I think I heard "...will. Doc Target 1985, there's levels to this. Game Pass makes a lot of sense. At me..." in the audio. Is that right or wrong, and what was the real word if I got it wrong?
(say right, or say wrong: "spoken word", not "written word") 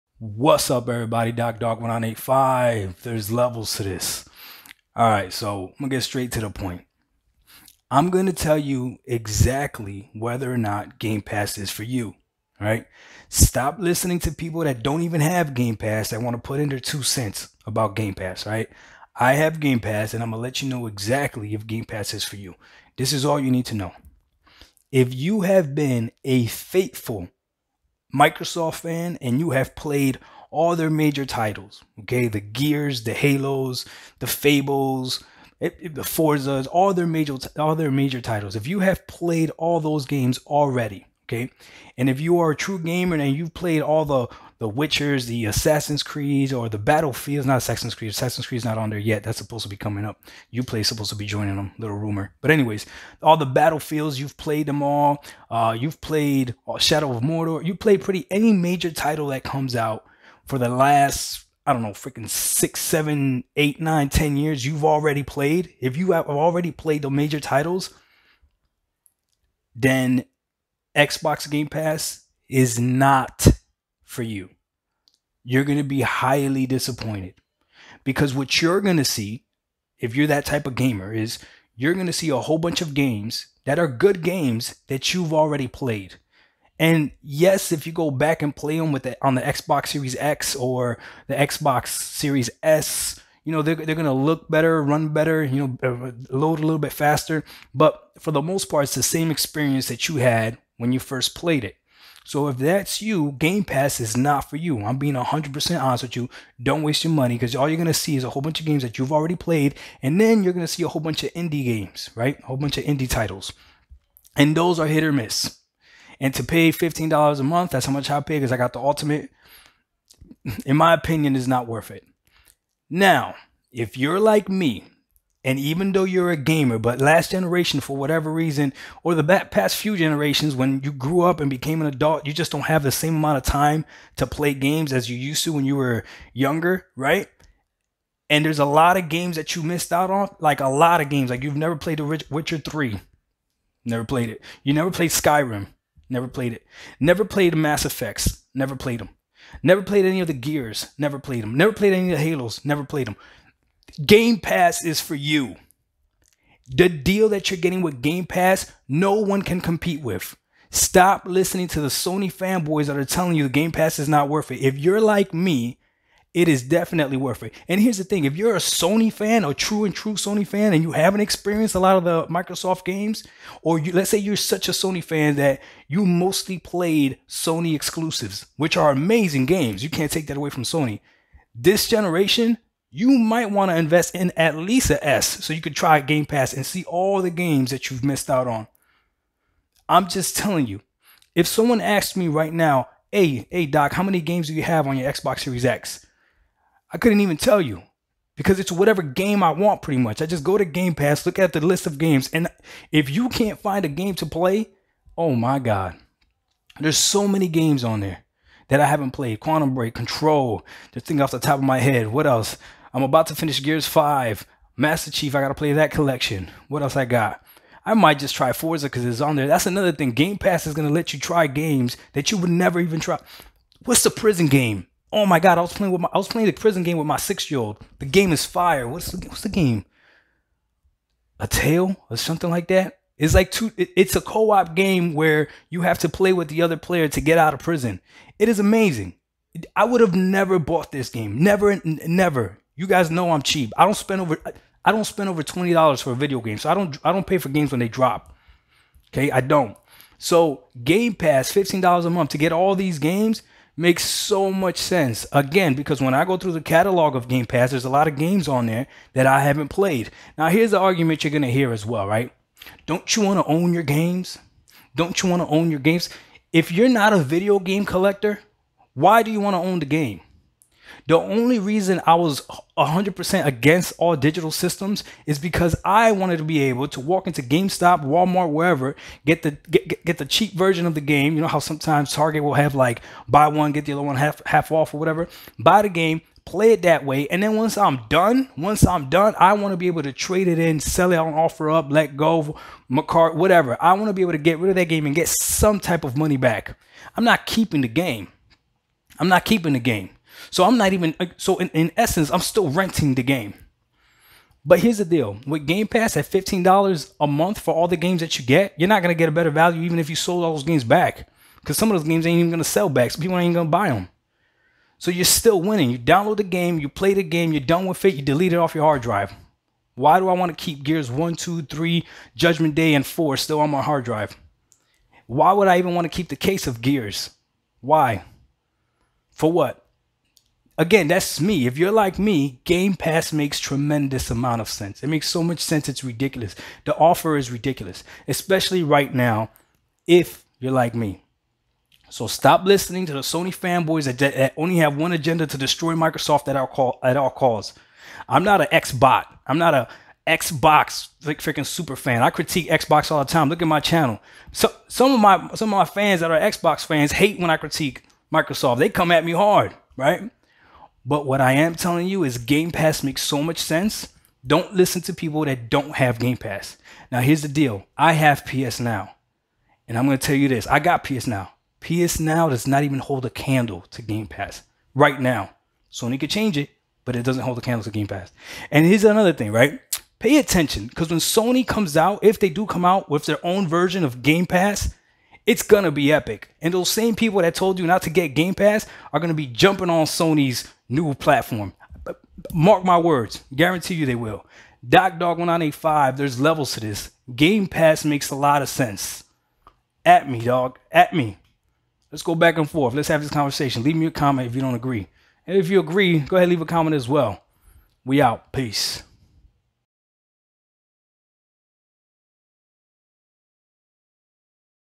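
wrong: "Dark", not "Target".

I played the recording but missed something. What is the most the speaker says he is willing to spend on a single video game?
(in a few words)
$20.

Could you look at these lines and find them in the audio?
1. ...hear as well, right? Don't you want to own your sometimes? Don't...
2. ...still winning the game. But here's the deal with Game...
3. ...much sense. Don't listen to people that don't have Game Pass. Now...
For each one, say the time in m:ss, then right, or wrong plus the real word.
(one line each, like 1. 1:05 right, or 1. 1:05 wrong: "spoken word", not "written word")
1. 4:21 wrong: "games", not "sometimes"
2. 5:02 wrong: "renting", not "winning"
3. 6:03 right.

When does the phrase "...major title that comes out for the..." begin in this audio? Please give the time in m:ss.
0:58.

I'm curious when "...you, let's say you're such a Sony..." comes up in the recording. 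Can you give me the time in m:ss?
2:53.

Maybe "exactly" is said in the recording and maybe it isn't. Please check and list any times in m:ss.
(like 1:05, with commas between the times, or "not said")
0:09, 0:20.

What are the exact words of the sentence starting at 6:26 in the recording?
And those same people that told you not to get Game Pass are going to be jumping on Sony's new platform.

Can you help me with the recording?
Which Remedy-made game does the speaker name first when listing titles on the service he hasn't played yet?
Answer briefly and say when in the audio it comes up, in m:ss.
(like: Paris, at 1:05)
Quantum Break, at 3:29.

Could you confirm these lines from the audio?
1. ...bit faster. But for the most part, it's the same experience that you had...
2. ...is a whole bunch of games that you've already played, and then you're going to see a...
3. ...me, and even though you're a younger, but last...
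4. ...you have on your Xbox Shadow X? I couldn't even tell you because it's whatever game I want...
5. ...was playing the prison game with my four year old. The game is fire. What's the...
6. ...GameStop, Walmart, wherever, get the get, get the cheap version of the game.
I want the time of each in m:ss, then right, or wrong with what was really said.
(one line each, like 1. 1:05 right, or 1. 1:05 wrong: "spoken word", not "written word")
1. 1:36 right
2. 1:48 right
3. 2:04 wrong: "gamer", not "younger"
4. 3:14 wrong: "Series", not "Shadow"
5. 3:46 wrong: "six", not "four"
6. 4:37 right.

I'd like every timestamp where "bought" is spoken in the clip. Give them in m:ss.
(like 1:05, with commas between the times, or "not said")
4:00.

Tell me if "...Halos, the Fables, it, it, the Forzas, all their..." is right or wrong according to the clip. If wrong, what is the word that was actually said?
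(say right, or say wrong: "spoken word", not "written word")
right.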